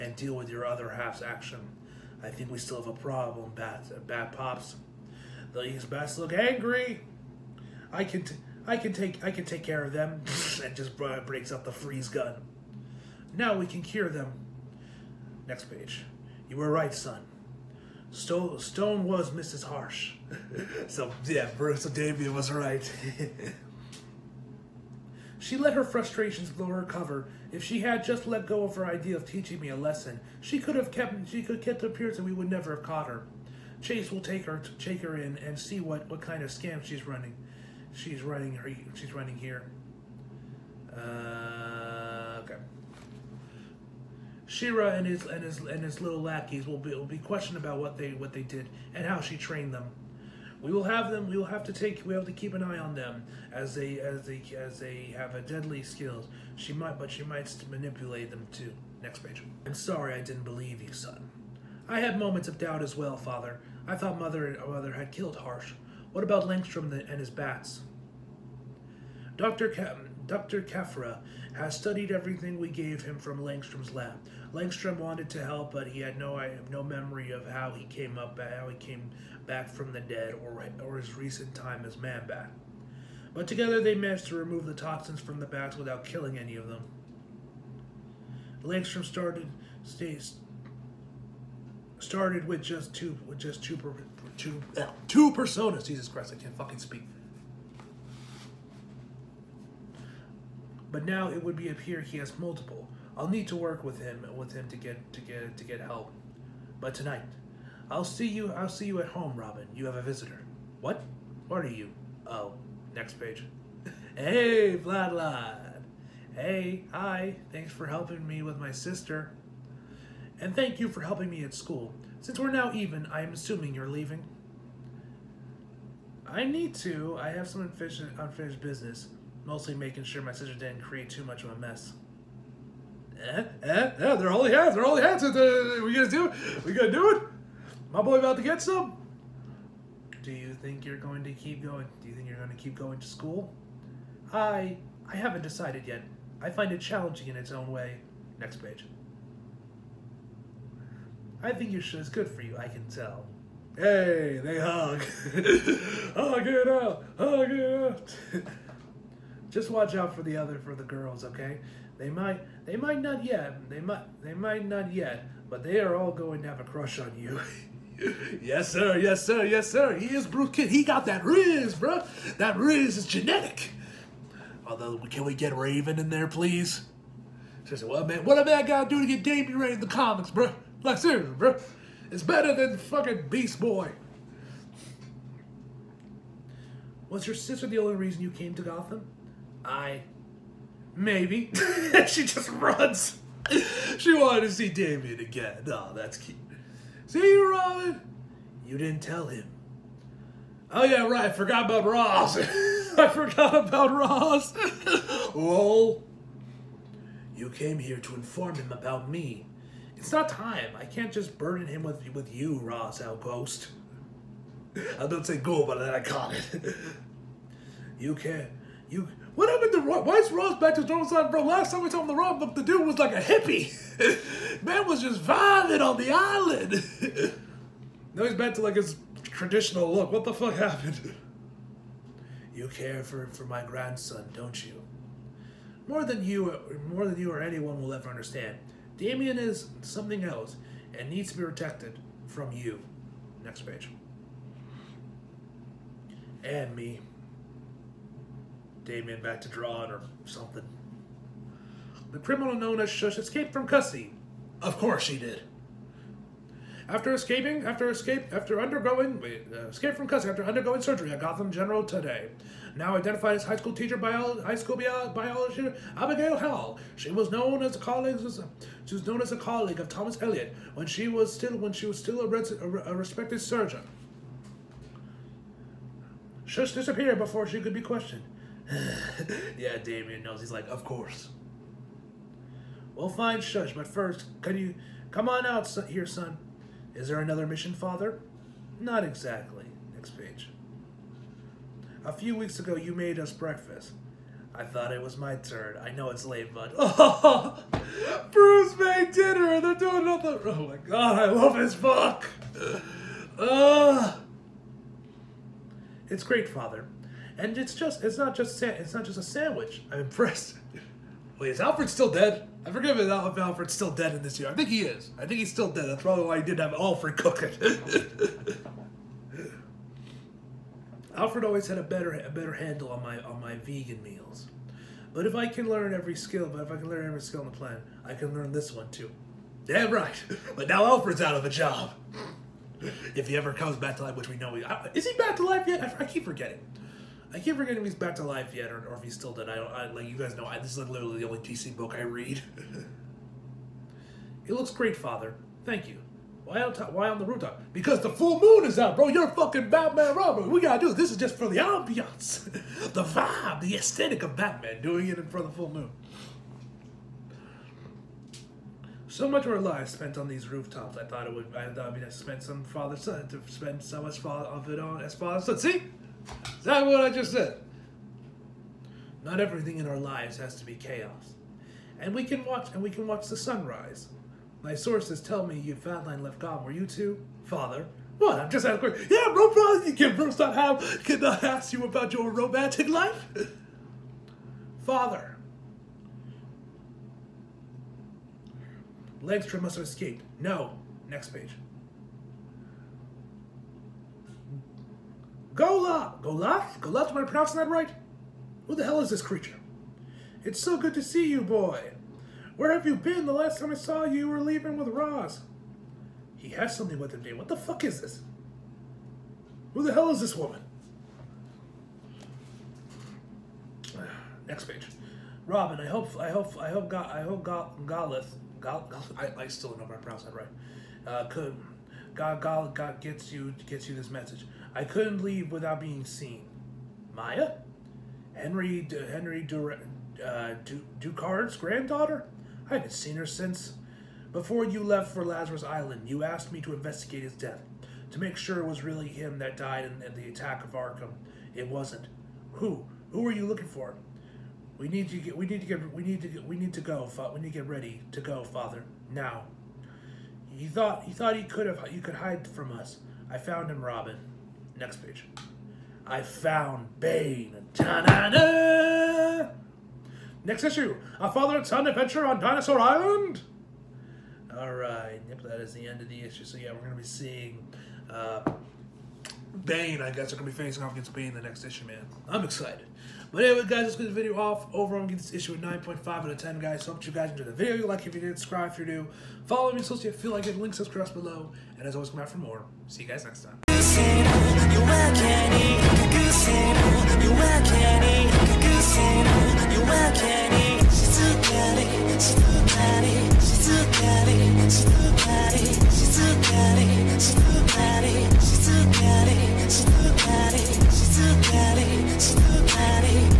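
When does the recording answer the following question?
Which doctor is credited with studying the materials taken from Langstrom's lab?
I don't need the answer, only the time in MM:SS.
01:10.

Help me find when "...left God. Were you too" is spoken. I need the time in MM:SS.
06:16.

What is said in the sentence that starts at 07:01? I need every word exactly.
Uh, could, God, God, God gets you, gets you this message.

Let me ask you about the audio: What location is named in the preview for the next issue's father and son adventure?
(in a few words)
Dinosaur Island.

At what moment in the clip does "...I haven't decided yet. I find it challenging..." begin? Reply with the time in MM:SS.
02:25.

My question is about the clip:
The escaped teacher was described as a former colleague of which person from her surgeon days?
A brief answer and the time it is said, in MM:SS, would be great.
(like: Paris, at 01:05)
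Thomas Elliot, at 04:29.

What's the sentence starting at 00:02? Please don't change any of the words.
I think we still have a problem, Bat Bat Pops.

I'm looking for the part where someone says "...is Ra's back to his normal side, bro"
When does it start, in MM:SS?
03:40.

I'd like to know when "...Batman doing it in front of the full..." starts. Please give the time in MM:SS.
05:54.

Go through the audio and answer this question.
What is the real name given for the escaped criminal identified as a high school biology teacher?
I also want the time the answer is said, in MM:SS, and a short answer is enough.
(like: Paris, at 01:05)
Abigail Hall, at 04:25.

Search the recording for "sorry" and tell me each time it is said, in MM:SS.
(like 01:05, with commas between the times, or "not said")
00:59.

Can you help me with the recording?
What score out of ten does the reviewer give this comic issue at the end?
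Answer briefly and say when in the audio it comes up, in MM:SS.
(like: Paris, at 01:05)
9.5, at 07:55.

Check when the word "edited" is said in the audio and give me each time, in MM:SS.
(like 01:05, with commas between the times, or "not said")
not said.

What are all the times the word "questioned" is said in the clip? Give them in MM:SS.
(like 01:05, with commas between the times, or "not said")
00:47, 04:37.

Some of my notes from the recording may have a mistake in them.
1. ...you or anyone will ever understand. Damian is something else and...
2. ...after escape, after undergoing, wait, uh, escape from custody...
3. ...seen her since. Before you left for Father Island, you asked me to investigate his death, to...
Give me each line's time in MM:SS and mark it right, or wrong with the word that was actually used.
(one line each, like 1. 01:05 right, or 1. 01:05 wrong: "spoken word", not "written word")
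1. 03:57 right
2. 04:17 right
3. 07:12 wrong: "Lazarus", not "Father".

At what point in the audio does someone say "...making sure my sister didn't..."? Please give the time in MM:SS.
02:09.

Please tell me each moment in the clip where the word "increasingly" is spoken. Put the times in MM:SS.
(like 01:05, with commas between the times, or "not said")
not said.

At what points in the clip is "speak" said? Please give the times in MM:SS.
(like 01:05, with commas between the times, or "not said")
01:36.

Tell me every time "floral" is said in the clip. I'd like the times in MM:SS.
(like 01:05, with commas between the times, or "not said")
not said.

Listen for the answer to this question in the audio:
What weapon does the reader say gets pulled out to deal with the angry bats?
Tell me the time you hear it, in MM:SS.
00:11.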